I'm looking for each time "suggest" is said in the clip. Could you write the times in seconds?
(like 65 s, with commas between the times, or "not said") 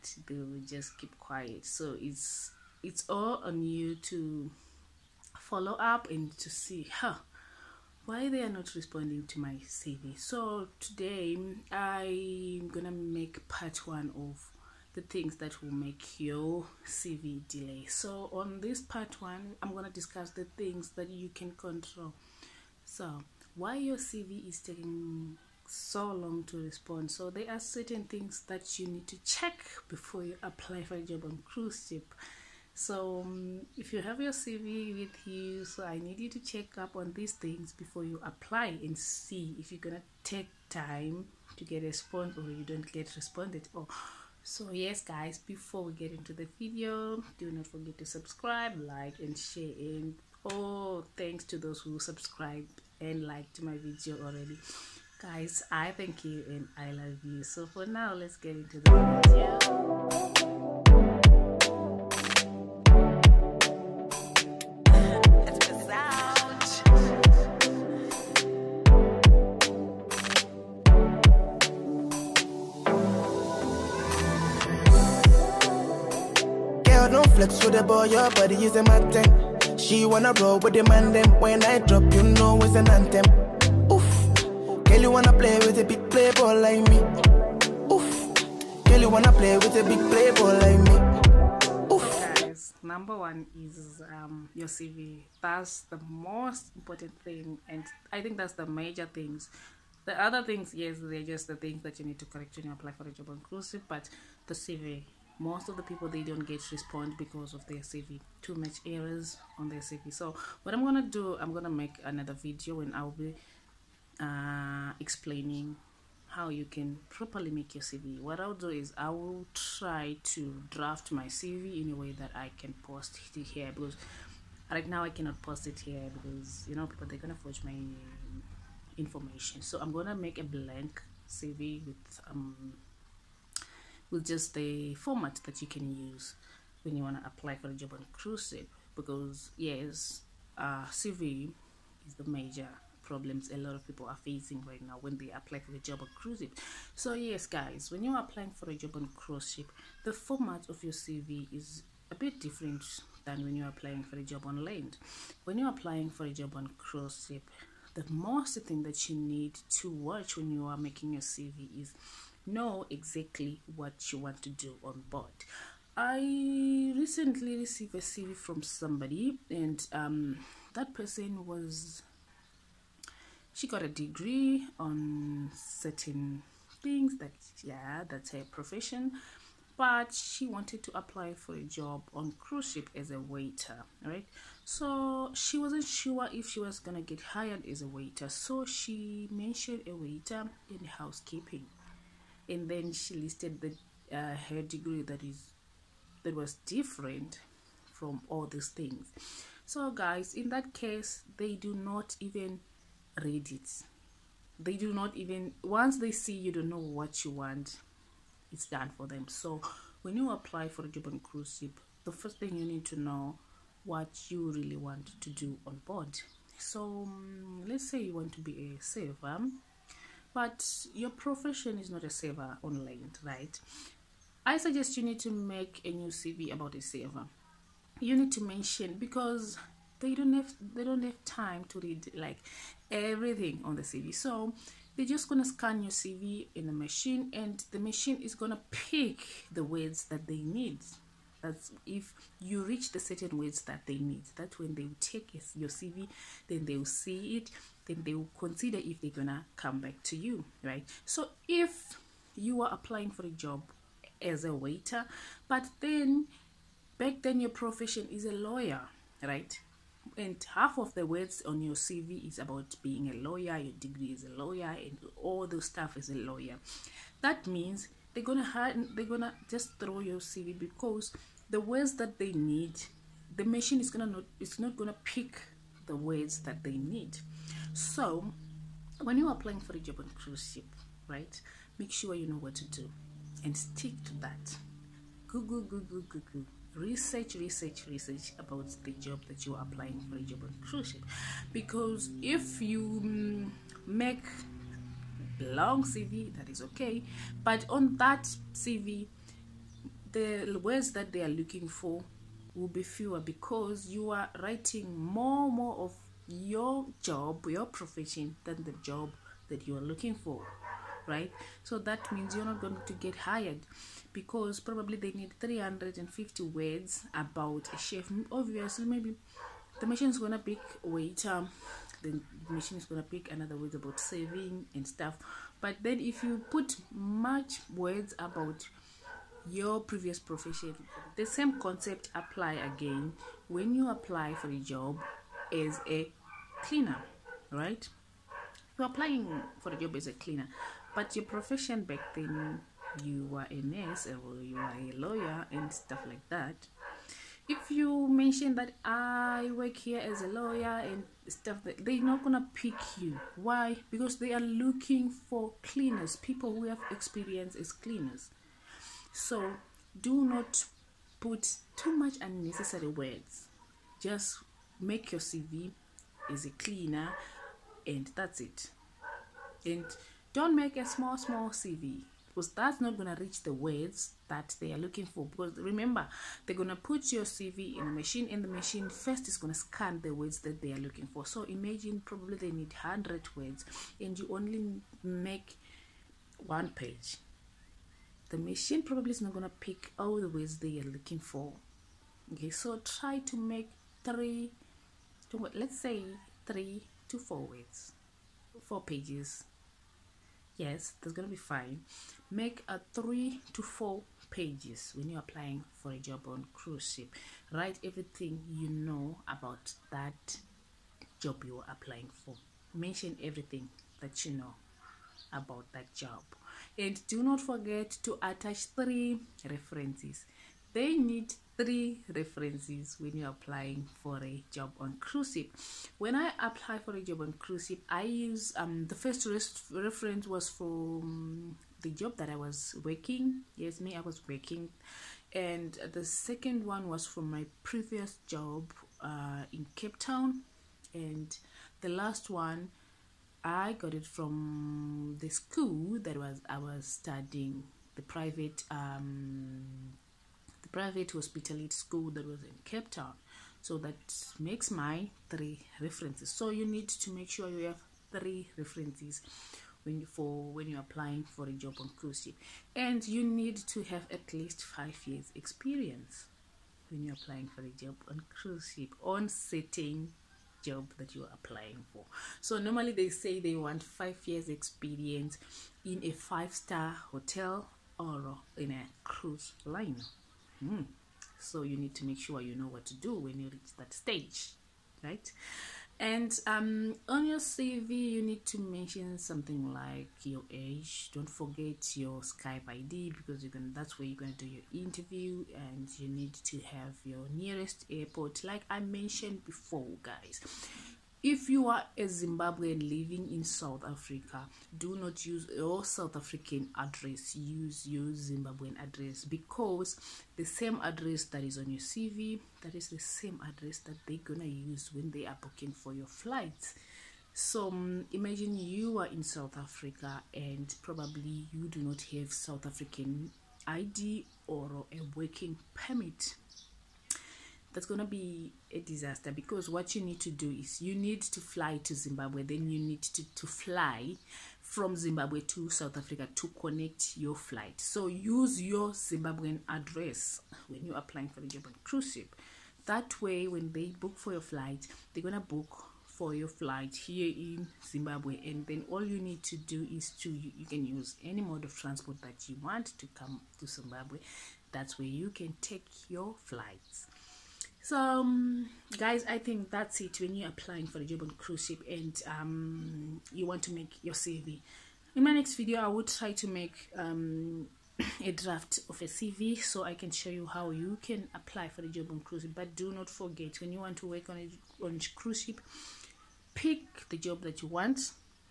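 224 s.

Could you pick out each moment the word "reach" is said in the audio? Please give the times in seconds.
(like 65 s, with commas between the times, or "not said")
242 s, 373 s, 483 s.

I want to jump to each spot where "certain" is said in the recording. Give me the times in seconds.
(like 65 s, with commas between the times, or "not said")
27 s, 175 s, 242 s.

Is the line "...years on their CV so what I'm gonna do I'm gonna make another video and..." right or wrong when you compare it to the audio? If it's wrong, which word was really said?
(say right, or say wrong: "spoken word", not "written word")
wrong: "errors", not "years".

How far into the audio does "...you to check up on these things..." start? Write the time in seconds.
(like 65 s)
36 s.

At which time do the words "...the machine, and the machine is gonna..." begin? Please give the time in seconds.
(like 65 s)
236 s.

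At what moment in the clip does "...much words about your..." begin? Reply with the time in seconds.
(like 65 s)
326 s.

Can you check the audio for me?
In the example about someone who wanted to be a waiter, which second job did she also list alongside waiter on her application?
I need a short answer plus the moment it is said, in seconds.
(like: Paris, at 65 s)
housekeeping, at 190 s.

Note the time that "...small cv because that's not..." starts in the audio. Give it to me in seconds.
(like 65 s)
371 s.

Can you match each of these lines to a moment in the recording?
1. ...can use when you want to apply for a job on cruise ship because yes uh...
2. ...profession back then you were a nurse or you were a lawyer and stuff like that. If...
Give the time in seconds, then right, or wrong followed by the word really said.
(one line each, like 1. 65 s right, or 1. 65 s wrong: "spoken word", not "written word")
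1. 135 s right
2. 341 s right.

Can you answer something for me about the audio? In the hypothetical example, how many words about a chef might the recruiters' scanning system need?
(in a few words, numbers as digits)
350.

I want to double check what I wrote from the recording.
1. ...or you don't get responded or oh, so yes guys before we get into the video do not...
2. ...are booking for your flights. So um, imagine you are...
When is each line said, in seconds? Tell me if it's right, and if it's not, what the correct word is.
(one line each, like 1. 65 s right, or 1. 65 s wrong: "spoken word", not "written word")
1. 42 s right
2. 515 s right.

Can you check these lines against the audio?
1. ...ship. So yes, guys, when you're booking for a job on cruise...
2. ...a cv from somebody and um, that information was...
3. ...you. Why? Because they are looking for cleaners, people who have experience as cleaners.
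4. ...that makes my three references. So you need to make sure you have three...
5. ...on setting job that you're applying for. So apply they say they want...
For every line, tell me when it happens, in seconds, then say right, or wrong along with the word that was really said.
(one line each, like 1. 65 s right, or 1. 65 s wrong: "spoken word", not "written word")
1. 146 s wrong: "applying", not "booking"
2. 167 s wrong: "person", not "information"
3. 352 s right
4. 453 s right
5. 469 s wrong: "normally", not "apply".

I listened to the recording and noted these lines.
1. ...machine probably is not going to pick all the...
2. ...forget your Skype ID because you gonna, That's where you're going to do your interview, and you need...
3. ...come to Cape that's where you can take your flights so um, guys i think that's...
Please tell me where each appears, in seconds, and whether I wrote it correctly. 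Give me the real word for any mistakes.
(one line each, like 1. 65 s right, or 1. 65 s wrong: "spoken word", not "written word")
1. 388 s right
2. 491 s right
3. 553 s wrong: "Zimbabwe", not "Cape".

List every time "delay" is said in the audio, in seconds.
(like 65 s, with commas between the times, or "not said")
17 s.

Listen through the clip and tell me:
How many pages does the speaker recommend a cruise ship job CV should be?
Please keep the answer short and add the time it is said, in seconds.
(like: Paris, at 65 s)
3 to 4, at 402 s.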